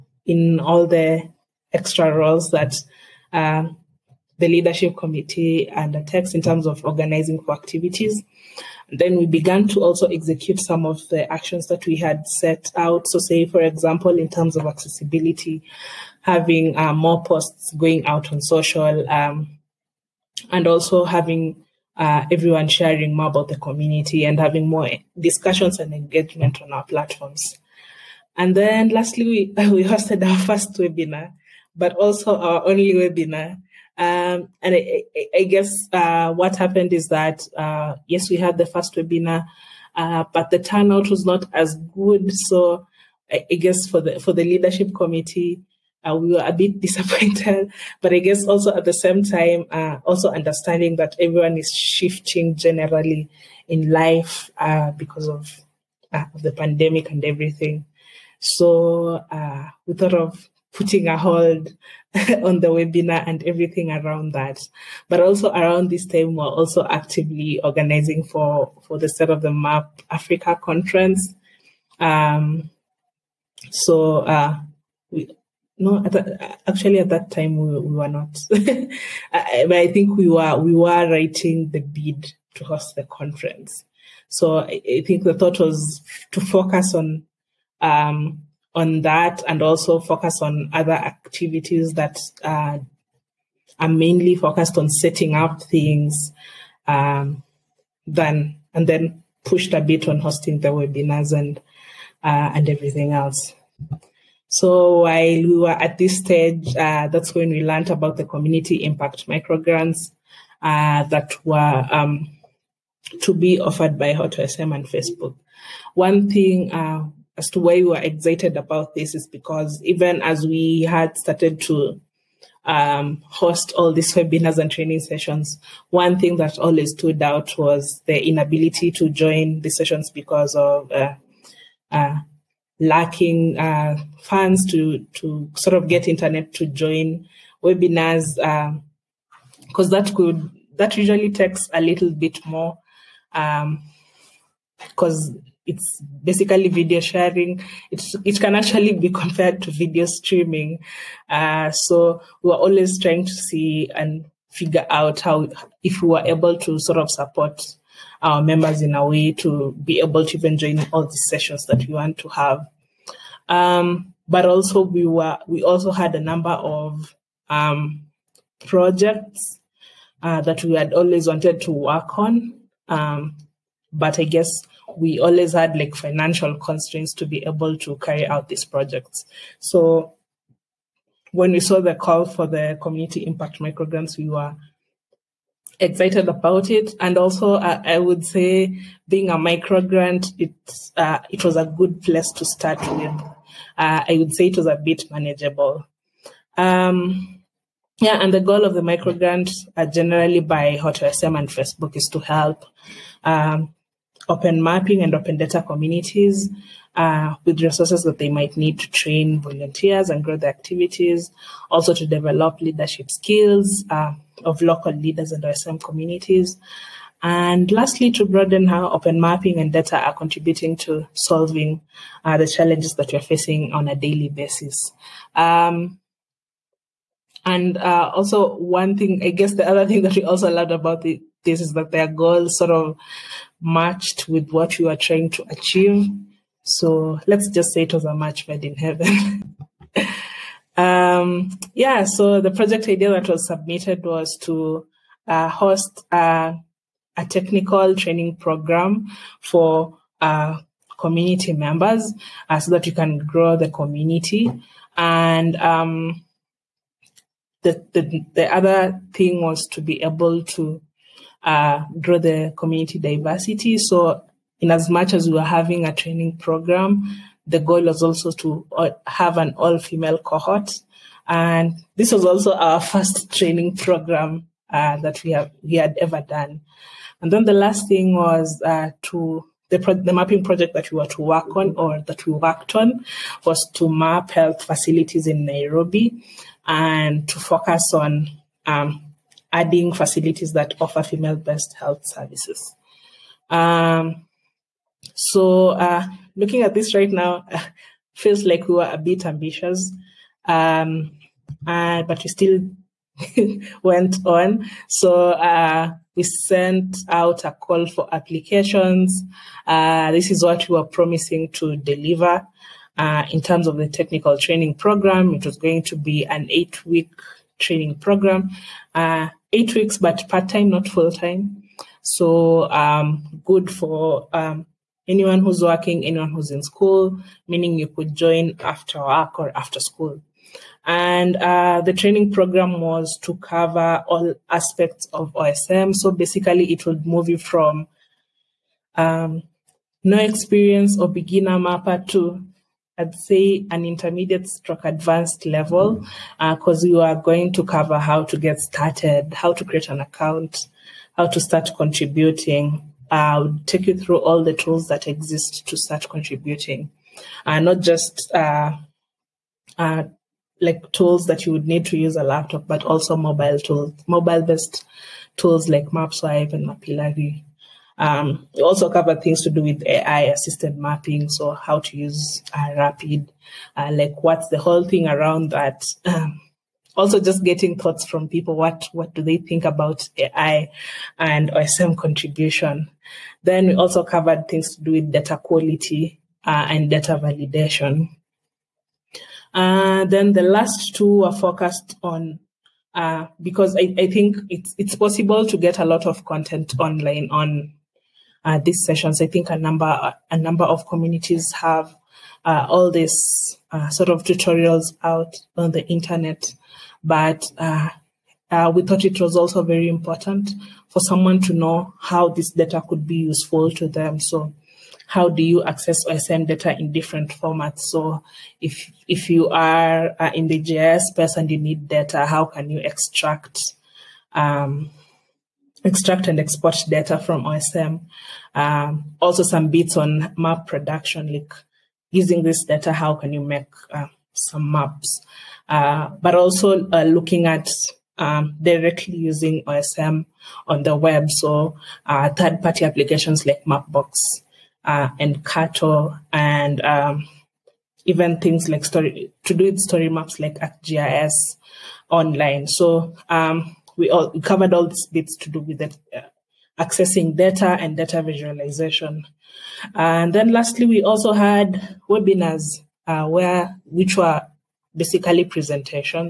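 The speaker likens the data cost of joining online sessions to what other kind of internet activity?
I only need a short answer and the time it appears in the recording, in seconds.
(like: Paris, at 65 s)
video streaming, at 149 s.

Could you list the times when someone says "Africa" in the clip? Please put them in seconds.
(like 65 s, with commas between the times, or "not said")
70 s.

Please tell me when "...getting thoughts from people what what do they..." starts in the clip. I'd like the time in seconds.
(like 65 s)
377 s.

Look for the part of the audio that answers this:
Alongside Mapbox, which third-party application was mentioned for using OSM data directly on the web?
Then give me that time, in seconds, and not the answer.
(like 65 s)
445 s.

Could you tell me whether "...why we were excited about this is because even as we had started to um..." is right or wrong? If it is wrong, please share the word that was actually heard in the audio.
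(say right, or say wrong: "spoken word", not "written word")
right.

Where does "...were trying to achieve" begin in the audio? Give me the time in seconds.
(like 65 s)
234 s.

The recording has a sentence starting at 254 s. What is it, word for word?
And um, the, the, the other thing was to be able to uh, grow the community diversity.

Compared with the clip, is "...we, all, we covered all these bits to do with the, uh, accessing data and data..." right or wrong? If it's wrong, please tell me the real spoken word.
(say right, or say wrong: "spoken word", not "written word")
right.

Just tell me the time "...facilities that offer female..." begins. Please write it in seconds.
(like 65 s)
289 s.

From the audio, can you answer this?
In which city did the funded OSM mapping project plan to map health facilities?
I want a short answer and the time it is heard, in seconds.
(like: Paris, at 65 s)
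Nairobi, at 285 s.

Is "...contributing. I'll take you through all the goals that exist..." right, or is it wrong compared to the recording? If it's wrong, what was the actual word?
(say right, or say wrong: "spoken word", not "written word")
wrong: "tools", not "goals".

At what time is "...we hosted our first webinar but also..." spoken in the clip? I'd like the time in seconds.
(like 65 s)
29 s.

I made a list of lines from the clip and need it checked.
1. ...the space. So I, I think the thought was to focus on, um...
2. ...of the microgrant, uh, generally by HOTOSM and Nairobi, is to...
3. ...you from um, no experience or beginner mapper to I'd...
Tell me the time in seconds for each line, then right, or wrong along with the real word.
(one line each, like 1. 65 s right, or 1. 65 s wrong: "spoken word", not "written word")
1. 82 s wrong: "conference", not "space"
2. 198 s wrong: "Facebook", not "Nairobi"
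3. 337 s right.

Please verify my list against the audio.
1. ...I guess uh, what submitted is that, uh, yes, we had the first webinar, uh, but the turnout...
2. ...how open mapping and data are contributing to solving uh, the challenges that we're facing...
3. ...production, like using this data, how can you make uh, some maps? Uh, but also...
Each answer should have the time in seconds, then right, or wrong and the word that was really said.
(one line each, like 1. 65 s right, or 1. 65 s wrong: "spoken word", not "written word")
1. 35 s wrong: "happened", not "submitted"
2. 218 s right
3. 430 s right.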